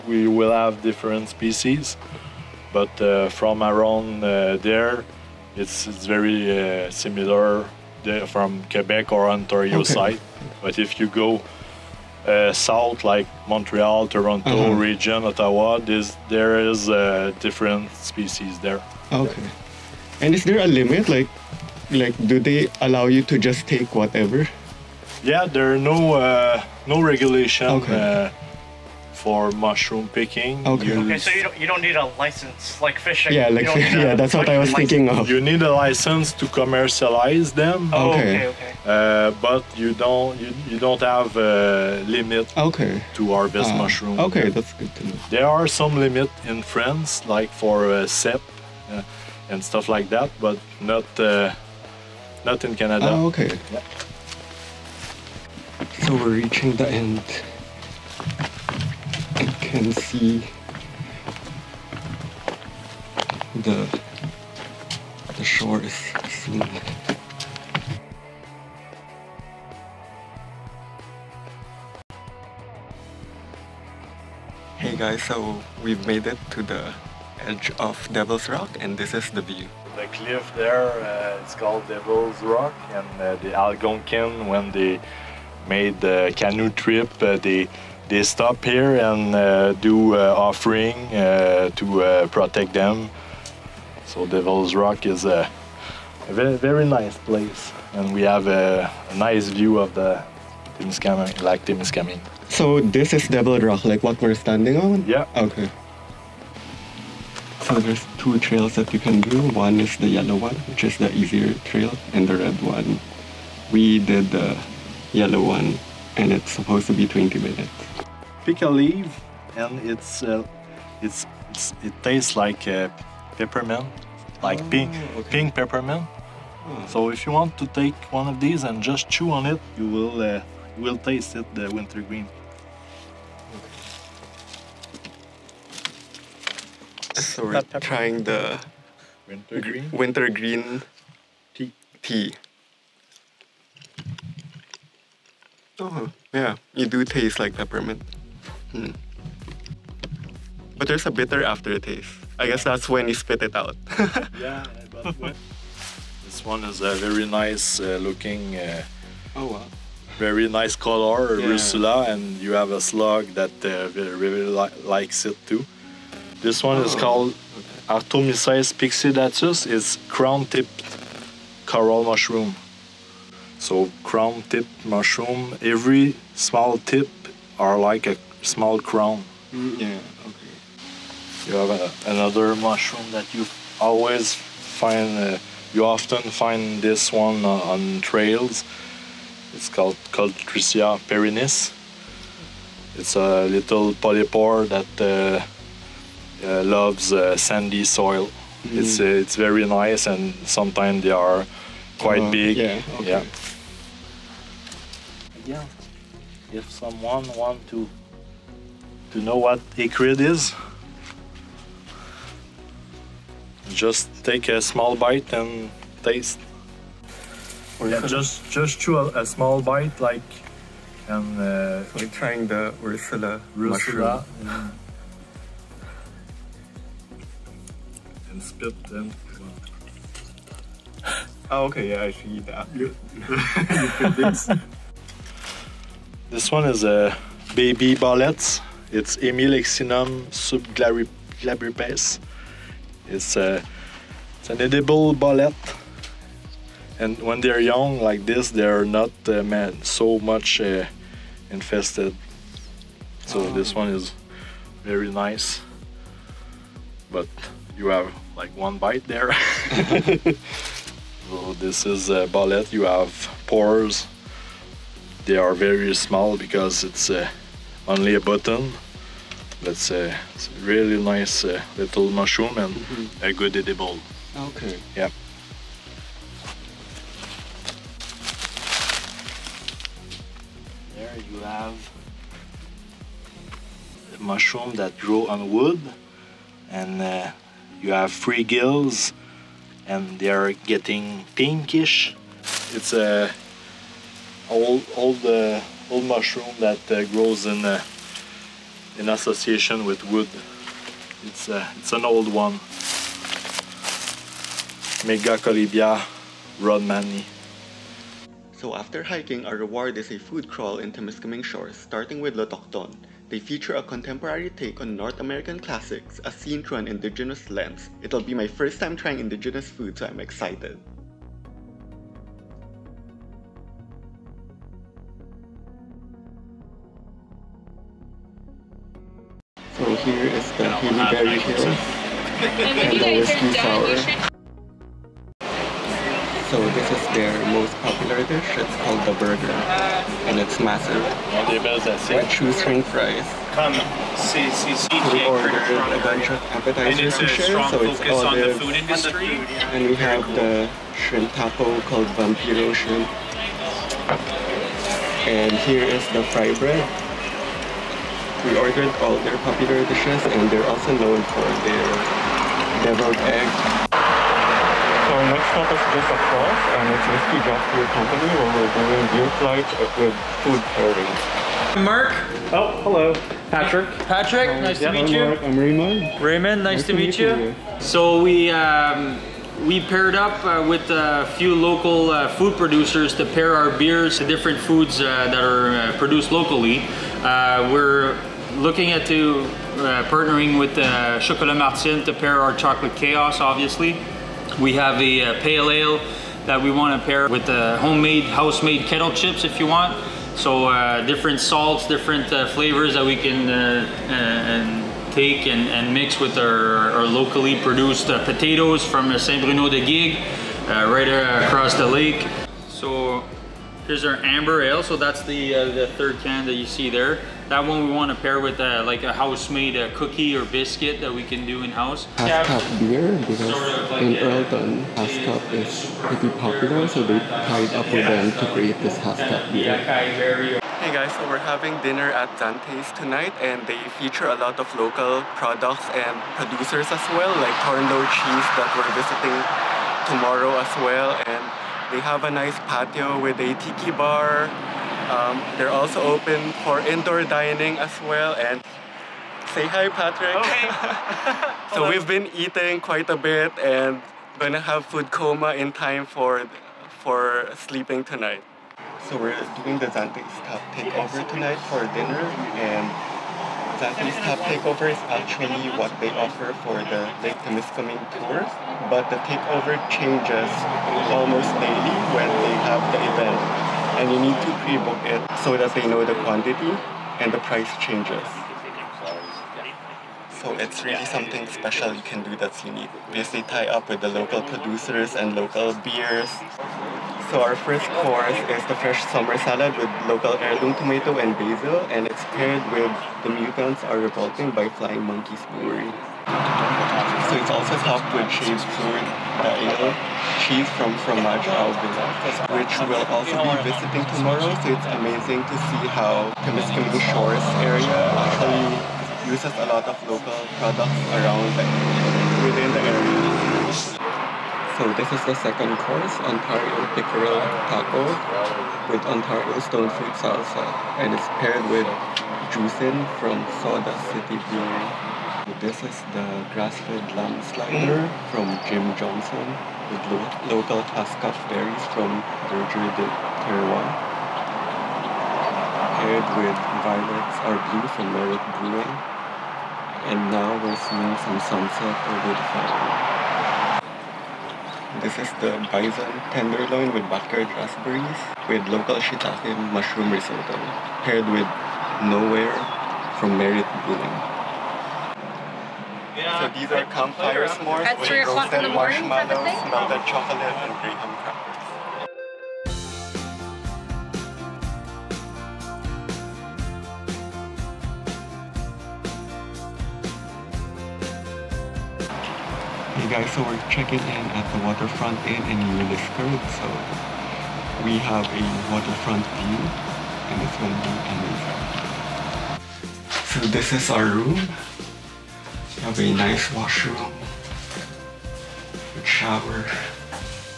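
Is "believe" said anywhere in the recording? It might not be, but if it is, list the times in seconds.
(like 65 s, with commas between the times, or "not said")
not said.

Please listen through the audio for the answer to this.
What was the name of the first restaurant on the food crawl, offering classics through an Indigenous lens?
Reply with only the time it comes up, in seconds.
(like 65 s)
312 s.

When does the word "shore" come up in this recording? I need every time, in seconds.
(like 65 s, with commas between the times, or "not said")
65 s, 311 s, 507 s.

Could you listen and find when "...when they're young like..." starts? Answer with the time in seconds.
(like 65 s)
247 s.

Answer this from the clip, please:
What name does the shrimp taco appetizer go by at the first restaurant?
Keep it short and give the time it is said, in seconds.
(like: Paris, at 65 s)
Vampiro shrimp, at 352 s.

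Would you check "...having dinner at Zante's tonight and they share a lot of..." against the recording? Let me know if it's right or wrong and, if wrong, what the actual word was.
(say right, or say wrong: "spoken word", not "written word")
wrong: "feature", not "share".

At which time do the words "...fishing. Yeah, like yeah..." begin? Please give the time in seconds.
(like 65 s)
32 s.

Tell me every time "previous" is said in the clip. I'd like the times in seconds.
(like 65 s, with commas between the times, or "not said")
not said.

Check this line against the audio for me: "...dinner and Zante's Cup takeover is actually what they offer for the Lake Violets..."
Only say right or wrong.
wrong.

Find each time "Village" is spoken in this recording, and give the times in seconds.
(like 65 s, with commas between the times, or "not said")
501 s.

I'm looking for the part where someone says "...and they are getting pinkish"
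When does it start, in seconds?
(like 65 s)
289 s.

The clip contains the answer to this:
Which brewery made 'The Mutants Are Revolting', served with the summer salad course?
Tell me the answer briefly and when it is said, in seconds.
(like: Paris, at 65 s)
Flying Monkeys Brewery, at 494 s.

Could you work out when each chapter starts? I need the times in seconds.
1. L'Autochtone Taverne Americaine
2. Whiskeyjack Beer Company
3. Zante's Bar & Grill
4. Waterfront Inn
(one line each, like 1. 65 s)
1. 307 s
2. 363 s
3. 430 s
4. 571 s.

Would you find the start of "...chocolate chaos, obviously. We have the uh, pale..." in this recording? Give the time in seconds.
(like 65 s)
392 s.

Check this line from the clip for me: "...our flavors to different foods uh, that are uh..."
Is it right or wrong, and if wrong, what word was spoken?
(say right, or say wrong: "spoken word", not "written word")
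wrong: "beers", not "flavors".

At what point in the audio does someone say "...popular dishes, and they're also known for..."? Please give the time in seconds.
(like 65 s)
359 s.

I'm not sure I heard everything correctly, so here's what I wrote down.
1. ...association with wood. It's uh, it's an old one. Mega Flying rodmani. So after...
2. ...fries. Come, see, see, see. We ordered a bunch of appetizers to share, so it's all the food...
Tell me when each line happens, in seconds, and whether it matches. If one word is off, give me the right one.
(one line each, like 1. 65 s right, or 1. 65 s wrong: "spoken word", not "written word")
1. 299 s wrong: "Colibia", not "Flying"
2. 342 s right.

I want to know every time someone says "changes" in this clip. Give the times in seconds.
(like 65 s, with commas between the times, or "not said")
469 s, 477 s.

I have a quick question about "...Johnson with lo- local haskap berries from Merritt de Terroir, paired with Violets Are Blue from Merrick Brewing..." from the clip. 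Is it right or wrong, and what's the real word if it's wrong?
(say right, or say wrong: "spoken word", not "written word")
wrong: "Derger", not "Merritt".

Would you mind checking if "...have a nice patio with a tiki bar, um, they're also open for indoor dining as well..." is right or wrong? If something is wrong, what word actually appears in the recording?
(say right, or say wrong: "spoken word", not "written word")
right.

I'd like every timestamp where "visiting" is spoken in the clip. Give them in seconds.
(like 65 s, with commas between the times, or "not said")
438 s, 503 s.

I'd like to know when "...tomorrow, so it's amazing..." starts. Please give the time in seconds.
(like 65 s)
504 s.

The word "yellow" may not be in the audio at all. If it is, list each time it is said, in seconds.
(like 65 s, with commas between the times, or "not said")
110 s, 115 s.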